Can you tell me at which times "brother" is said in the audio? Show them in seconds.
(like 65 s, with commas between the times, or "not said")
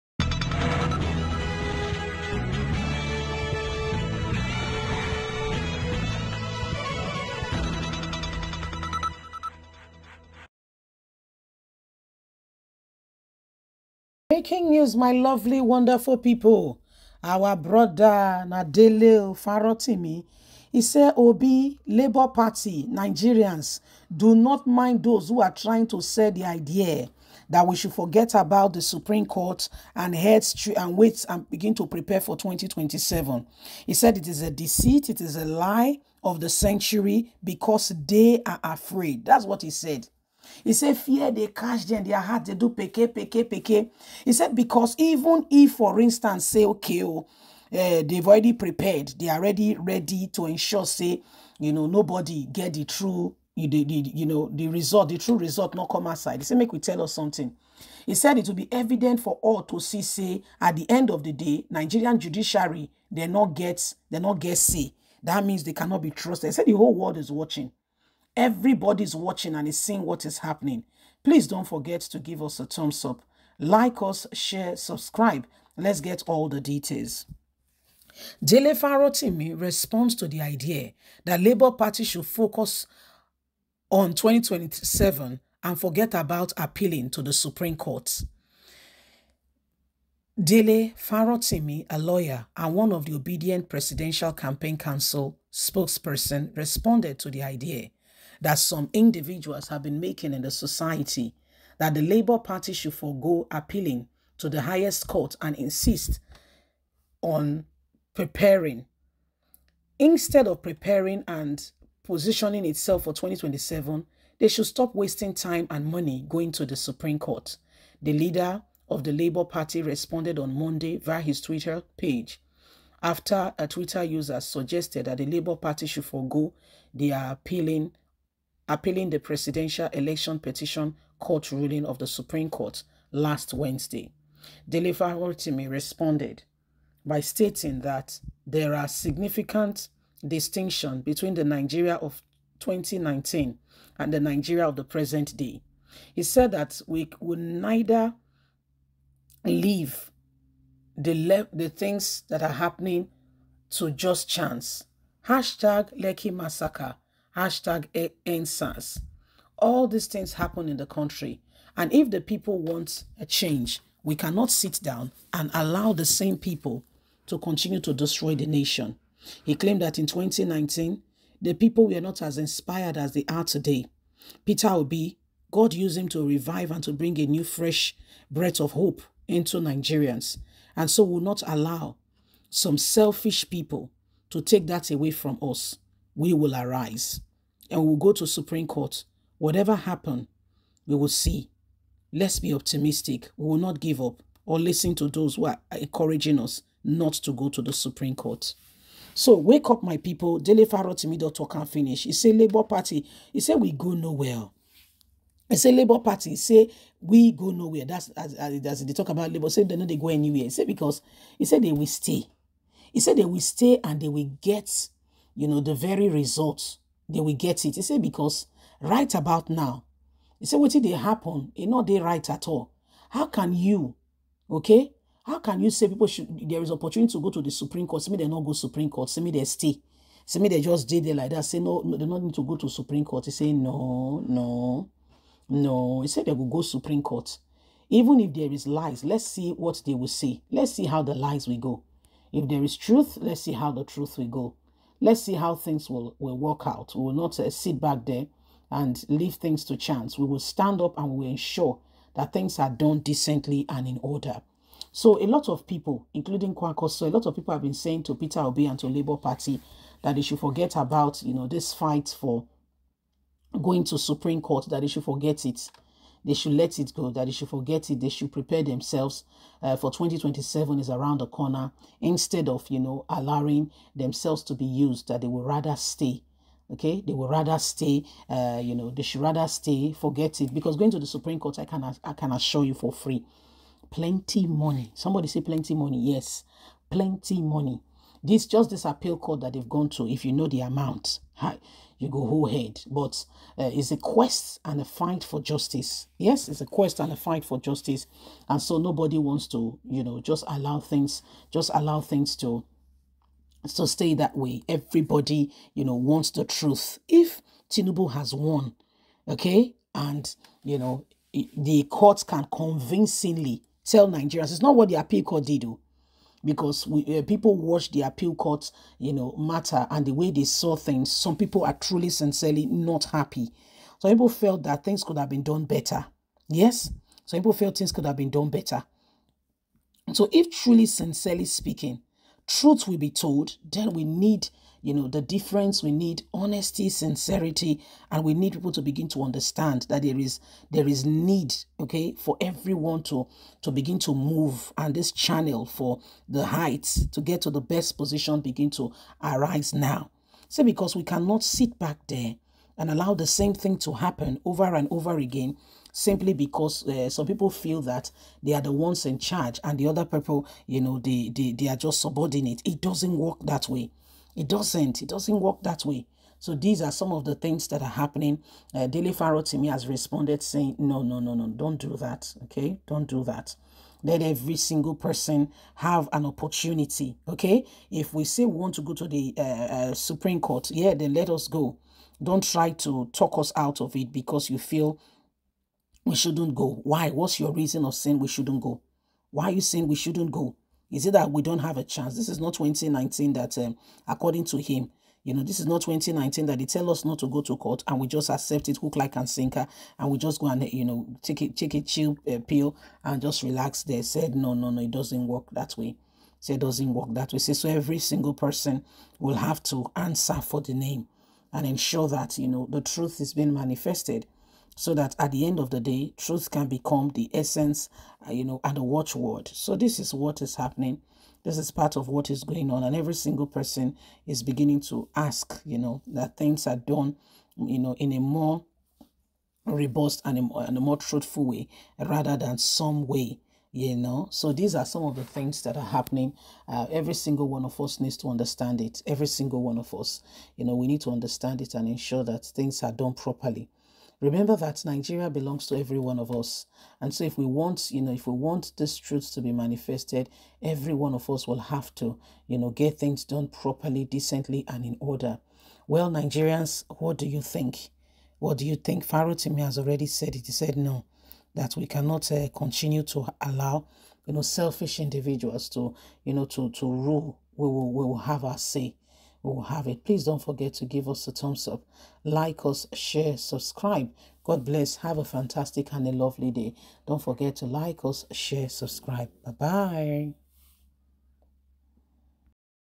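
17 s.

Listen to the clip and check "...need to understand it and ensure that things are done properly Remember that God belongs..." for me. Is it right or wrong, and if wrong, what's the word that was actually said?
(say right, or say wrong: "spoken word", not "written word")
wrong: "Nigeria", not "God".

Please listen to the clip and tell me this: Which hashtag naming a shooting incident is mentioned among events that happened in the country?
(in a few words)
Lekki Massacre.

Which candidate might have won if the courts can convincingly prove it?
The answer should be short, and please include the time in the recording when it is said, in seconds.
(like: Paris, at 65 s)
Tinubu, at 307 s.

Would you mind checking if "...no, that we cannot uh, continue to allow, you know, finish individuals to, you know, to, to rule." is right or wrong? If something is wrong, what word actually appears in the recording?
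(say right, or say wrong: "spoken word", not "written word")
wrong: "selfish", not "finish".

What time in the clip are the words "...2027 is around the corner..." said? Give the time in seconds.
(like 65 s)
269 s.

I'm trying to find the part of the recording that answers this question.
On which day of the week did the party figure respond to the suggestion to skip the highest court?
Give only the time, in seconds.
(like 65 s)
120 s.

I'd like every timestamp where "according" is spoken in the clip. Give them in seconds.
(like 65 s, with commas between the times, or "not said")
394 s.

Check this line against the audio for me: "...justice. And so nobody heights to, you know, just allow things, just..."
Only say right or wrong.
wrong.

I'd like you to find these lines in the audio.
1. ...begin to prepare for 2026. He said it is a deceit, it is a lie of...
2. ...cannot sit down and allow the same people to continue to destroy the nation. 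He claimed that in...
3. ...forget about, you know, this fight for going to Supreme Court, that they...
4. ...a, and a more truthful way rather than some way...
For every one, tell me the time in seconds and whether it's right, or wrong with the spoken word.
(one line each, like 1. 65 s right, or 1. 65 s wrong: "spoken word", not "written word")
1. 31 s wrong: "2027", not "2026"
2. 164 s right
3. 260 s right
4. 430 s right.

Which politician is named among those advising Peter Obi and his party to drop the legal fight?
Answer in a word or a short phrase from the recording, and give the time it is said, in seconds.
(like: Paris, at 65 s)
Kwankwaso, at 256 s.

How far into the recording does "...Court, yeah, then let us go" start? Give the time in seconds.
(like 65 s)
380 s.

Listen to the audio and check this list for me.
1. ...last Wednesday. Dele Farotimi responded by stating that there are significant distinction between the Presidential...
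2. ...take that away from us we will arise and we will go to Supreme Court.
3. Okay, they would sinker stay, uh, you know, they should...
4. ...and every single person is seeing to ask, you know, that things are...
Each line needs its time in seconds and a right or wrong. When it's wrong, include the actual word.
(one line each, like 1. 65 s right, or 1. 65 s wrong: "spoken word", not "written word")
1. 133 s wrong: "Nigeria", not "Presidential"
2. 184 s right
3. 276 s wrong: "rather", not "sinker"
4. 422 s wrong: "beginning", not "seeing".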